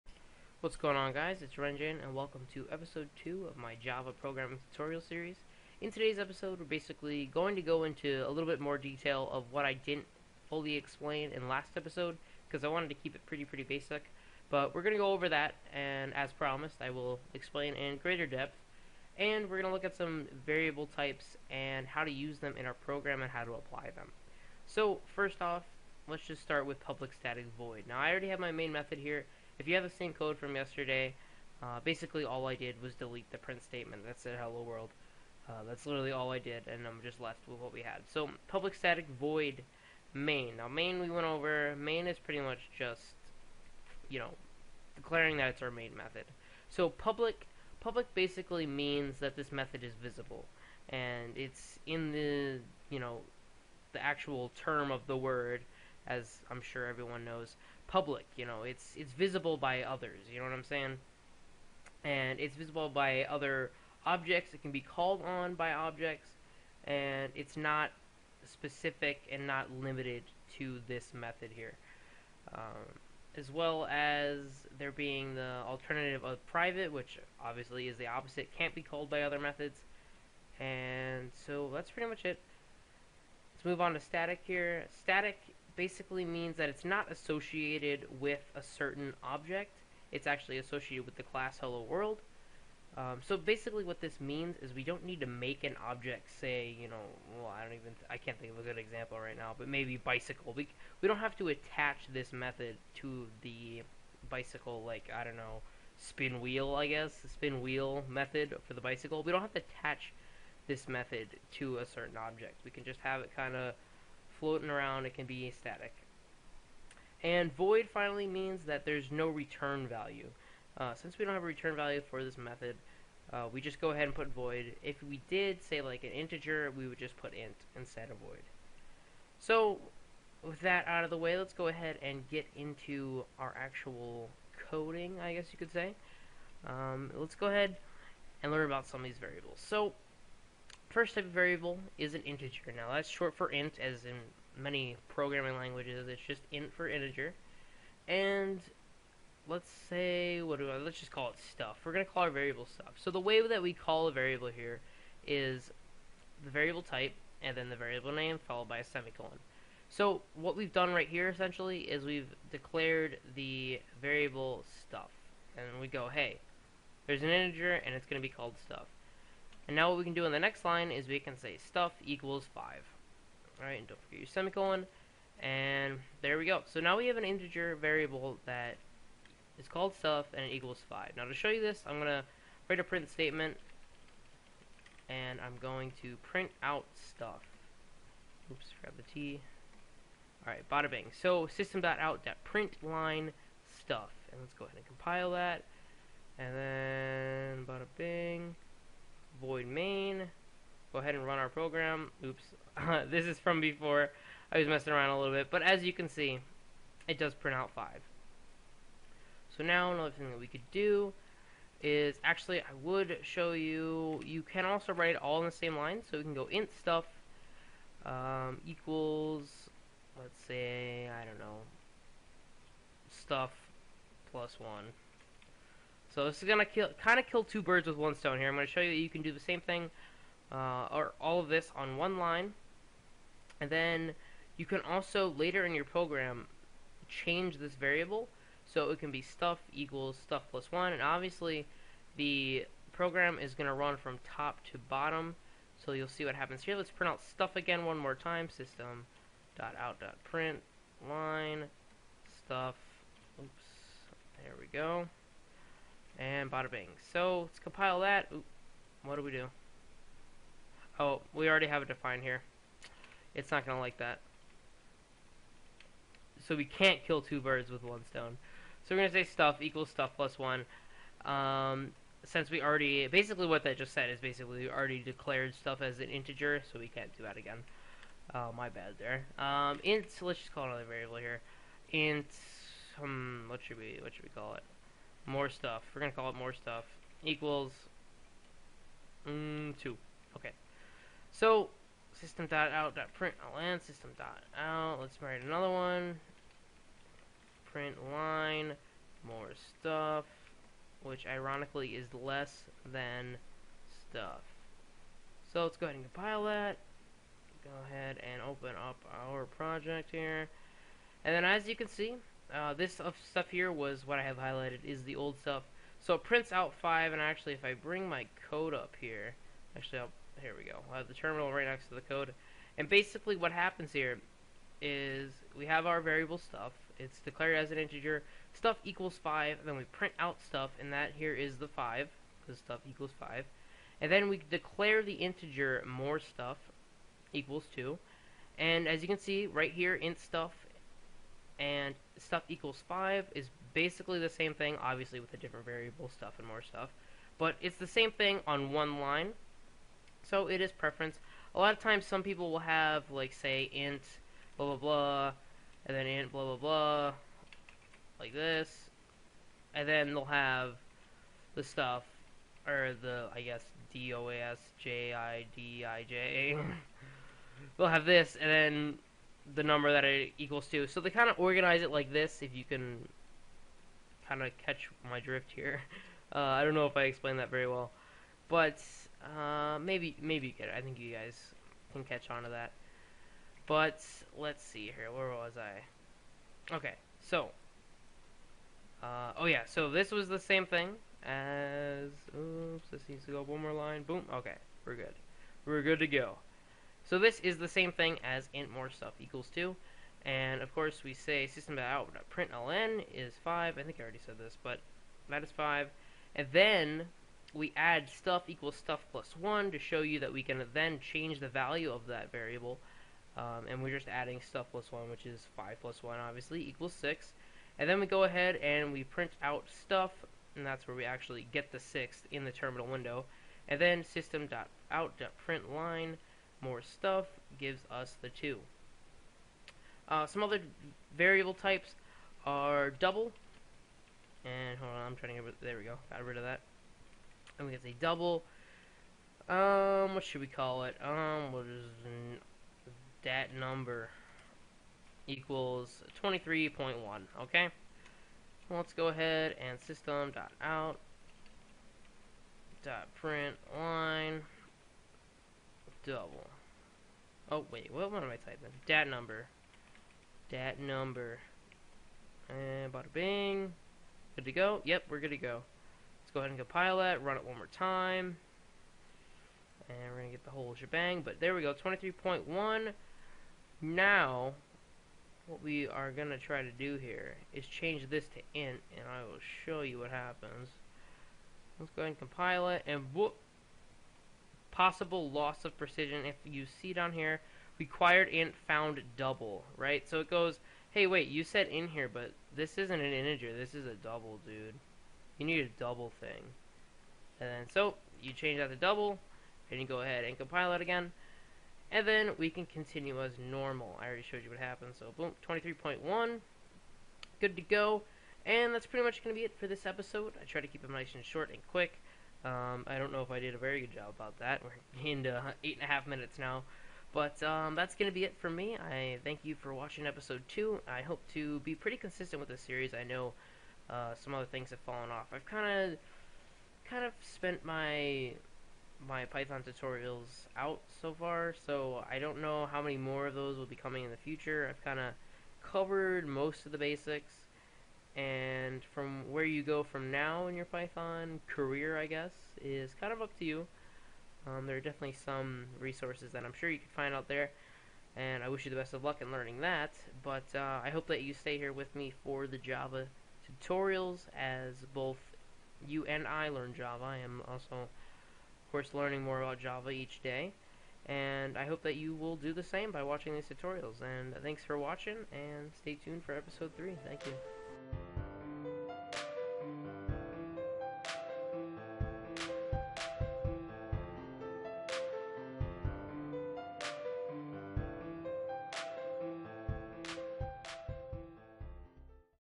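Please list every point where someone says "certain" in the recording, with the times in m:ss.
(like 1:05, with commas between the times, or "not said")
1:28, 1:51.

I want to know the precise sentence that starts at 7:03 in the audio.
And then system.out.println more stuff gives us the 2.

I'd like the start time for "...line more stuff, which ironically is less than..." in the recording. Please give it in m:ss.
4:58.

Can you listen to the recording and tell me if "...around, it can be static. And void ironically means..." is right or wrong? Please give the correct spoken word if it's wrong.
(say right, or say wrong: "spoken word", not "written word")
wrong: "finally", not "ironically".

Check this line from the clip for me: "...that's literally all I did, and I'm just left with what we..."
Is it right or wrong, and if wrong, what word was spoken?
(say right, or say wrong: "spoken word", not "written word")
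right.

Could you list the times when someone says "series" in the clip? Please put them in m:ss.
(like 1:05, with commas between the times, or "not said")
0:05, 8:42.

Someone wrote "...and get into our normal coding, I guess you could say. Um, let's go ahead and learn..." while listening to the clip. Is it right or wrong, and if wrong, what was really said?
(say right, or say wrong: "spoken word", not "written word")
wrong: "actual", not "normal".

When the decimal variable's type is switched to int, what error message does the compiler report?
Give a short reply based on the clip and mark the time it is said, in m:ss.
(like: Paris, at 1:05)
possible loss of precision, at 8:04.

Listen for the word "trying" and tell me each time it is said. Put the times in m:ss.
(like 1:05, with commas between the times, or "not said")
7:15.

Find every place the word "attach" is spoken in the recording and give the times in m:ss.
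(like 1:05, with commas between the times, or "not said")
1:41, 1:49.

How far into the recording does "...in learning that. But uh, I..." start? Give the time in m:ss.
9:09.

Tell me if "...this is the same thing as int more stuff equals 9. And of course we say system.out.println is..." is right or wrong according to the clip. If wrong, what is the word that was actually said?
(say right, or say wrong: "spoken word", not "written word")
wrong: "2", not "9".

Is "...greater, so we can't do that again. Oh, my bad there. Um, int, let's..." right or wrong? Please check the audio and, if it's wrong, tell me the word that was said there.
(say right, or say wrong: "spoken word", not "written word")
wrong: "integer", not "greater".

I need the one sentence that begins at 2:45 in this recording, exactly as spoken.
And we go, hey, there's an integer and it's going to be called stuff.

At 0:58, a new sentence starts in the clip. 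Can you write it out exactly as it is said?
You know, it's it's visible by others.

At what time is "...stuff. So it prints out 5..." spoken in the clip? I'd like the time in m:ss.
5:15.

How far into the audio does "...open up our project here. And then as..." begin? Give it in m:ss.
5:08.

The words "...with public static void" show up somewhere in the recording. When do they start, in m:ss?
0:26.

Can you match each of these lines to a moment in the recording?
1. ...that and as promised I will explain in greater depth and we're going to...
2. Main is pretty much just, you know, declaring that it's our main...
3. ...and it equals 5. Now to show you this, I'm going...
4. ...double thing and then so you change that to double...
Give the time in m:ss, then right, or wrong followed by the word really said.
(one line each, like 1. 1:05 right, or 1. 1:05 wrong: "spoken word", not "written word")
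1. 0:15 right
2. 0:41 right
3. 3:00 right
4. 8:15 right.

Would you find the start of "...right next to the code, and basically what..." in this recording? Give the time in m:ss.
5:21.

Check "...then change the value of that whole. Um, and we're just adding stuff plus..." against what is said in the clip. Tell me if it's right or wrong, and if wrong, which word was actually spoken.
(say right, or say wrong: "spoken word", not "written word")
wrong: "variable", not "whole".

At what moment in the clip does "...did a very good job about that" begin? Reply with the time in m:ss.
8:33.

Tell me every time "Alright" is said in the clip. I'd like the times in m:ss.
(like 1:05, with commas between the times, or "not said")
2:53, 3:10.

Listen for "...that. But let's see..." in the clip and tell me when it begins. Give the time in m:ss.
6:22.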